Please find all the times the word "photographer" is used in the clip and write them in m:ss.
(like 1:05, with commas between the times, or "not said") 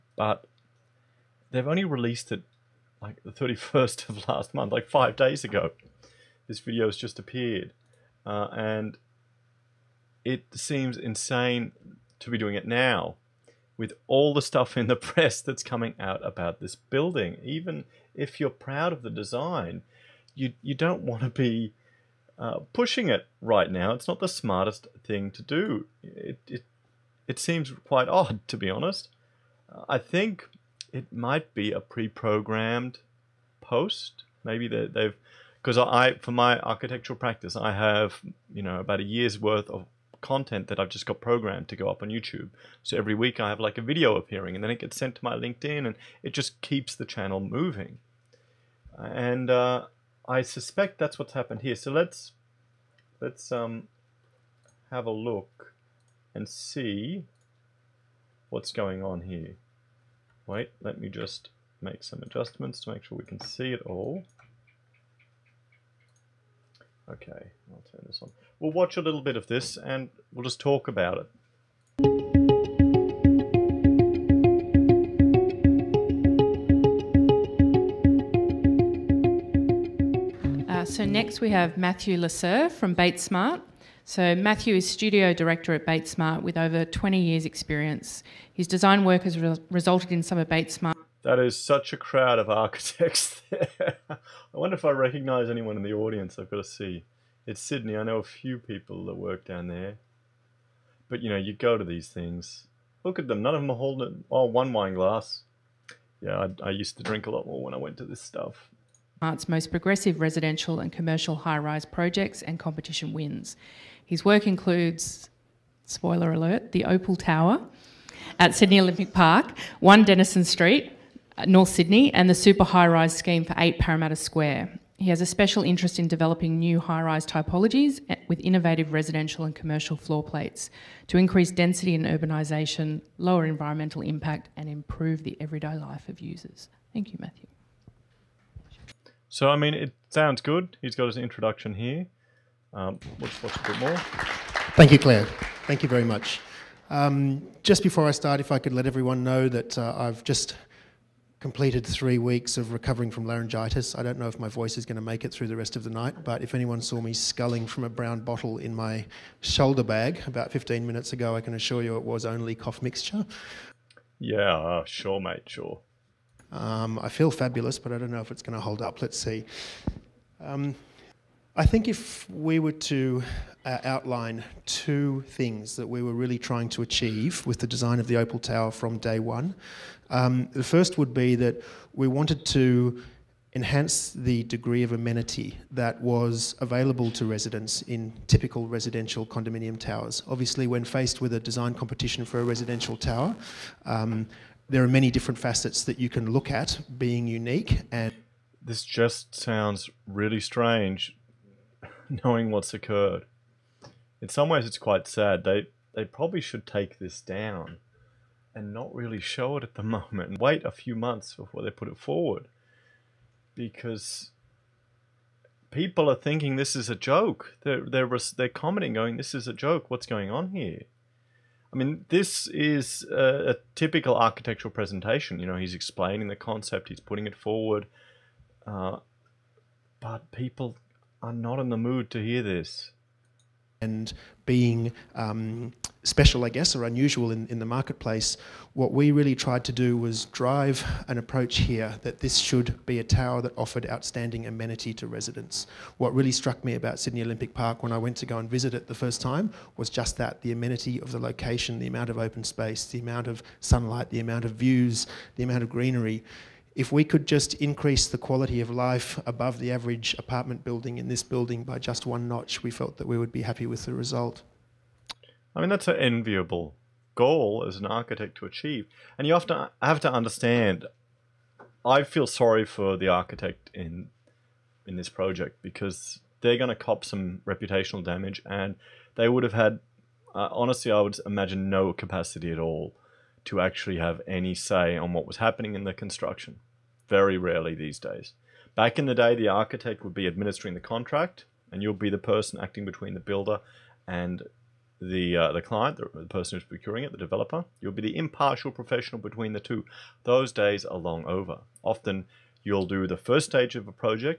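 not said.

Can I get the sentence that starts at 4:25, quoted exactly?
I mean, that's an enviable goal as an architect to achieve.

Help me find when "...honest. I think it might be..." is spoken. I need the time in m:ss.
0:28.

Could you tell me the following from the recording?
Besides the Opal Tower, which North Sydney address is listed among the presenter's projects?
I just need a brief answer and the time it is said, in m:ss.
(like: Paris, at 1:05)
1 Denison Street, at 1:59.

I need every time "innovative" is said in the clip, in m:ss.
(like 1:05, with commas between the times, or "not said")
2:08.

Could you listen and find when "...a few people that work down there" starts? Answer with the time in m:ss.
1:38.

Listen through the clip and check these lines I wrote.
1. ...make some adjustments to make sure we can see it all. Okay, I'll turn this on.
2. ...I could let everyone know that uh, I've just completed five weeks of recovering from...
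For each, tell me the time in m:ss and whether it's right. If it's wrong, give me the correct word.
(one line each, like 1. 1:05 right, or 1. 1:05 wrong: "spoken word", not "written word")
1. 1:01 right
2. 2:28 wrong: "three", not "five".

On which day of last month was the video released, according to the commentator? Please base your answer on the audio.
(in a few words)
31st.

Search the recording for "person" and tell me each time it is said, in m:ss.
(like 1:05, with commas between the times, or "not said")
4:52, 4:56.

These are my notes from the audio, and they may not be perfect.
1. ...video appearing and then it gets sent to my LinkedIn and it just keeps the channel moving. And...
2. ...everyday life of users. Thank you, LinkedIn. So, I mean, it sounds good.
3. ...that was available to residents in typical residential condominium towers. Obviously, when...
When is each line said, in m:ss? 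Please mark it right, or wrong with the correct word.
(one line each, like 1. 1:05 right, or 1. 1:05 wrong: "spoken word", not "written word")
1. 0:43 right
2. 2:15 wrong: "Matthew", not "LinkedIn"
3. 3:05 right.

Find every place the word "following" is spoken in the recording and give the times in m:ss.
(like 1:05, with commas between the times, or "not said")
not said.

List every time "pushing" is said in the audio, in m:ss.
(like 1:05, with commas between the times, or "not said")
0:22.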